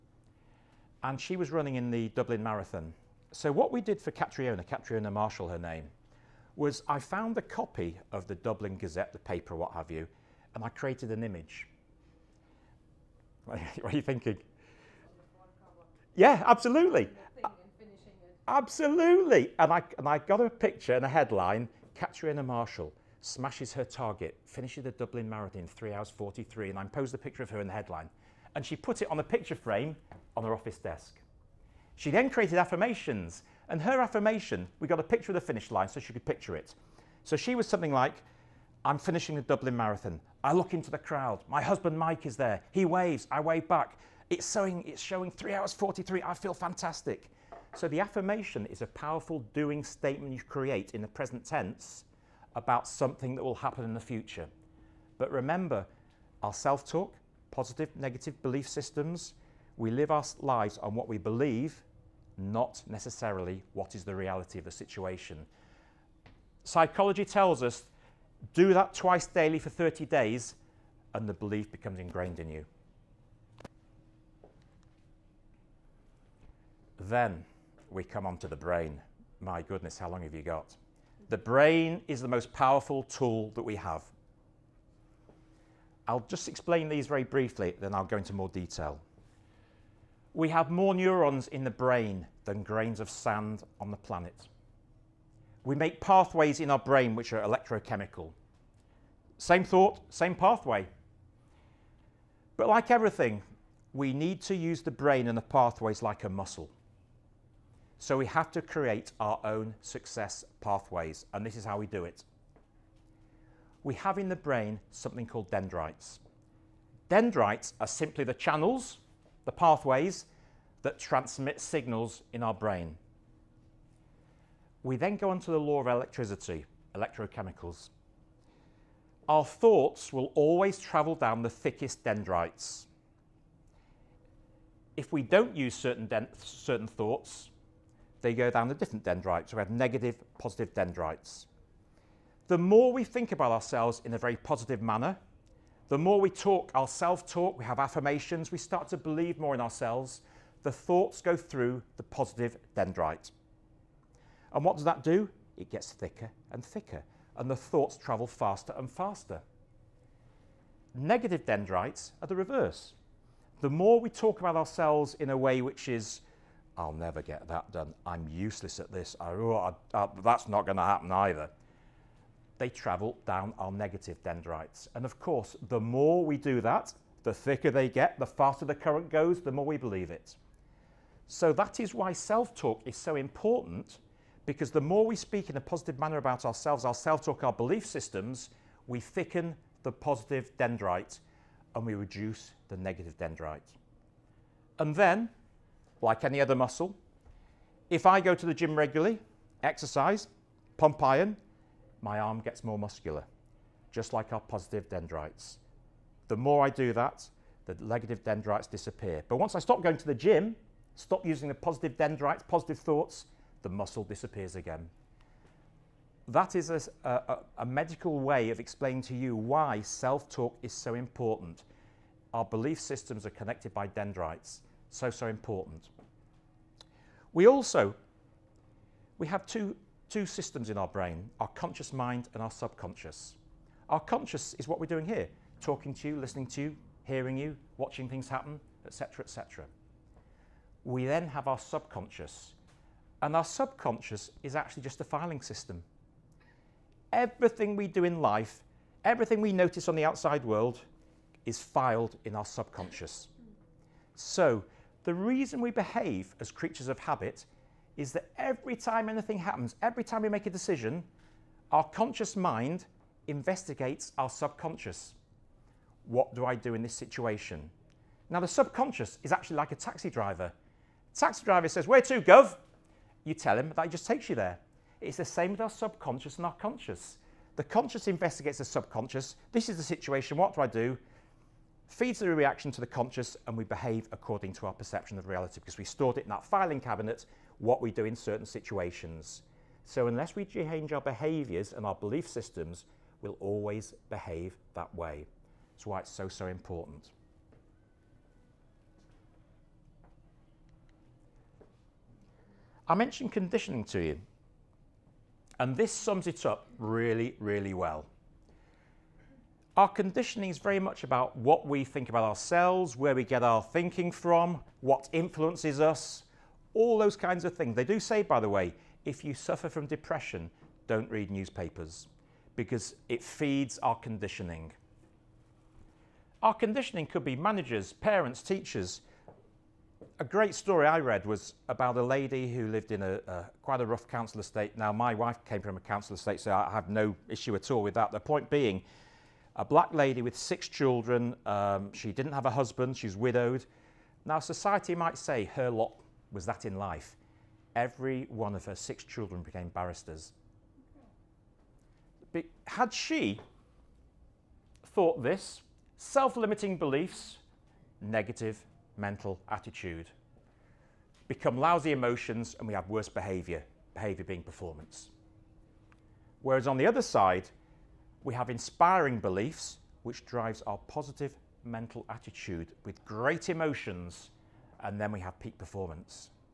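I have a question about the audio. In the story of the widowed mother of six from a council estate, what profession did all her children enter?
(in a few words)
Barristers.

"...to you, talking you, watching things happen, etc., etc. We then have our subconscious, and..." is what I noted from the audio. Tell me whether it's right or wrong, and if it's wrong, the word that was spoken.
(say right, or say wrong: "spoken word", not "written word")
wrong: "hearing", not "talking".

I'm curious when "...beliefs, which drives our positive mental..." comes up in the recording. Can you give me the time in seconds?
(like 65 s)
369 s.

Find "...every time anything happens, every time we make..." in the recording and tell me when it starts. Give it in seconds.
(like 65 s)
258 s.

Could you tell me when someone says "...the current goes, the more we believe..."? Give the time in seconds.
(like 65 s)
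178 s.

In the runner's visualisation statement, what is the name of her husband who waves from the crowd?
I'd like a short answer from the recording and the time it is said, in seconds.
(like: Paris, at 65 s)
Mike, at 41 s.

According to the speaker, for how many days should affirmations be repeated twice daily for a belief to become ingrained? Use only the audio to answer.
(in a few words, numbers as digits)
30.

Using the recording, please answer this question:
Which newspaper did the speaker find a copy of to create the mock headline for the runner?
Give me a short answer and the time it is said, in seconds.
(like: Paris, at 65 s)
Dublin Gazette, at 8 s.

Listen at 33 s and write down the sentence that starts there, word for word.
And her affirmation, we got a picture of the finish line so she could picture it.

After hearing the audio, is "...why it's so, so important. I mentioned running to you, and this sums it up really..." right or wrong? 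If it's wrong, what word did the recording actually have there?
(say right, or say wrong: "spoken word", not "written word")
wrong: "conditioning", not "running".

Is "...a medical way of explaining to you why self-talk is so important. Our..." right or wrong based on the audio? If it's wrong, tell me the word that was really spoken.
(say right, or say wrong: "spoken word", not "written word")
right.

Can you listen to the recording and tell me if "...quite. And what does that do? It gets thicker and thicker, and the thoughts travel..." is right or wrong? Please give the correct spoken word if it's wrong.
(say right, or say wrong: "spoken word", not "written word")
wrong: "dendrite", not "quite".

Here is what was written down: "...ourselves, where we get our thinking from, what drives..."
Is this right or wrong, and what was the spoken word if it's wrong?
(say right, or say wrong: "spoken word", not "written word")
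wrong: "influences", not "drives".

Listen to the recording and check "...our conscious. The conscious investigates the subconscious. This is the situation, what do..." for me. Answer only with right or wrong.
right.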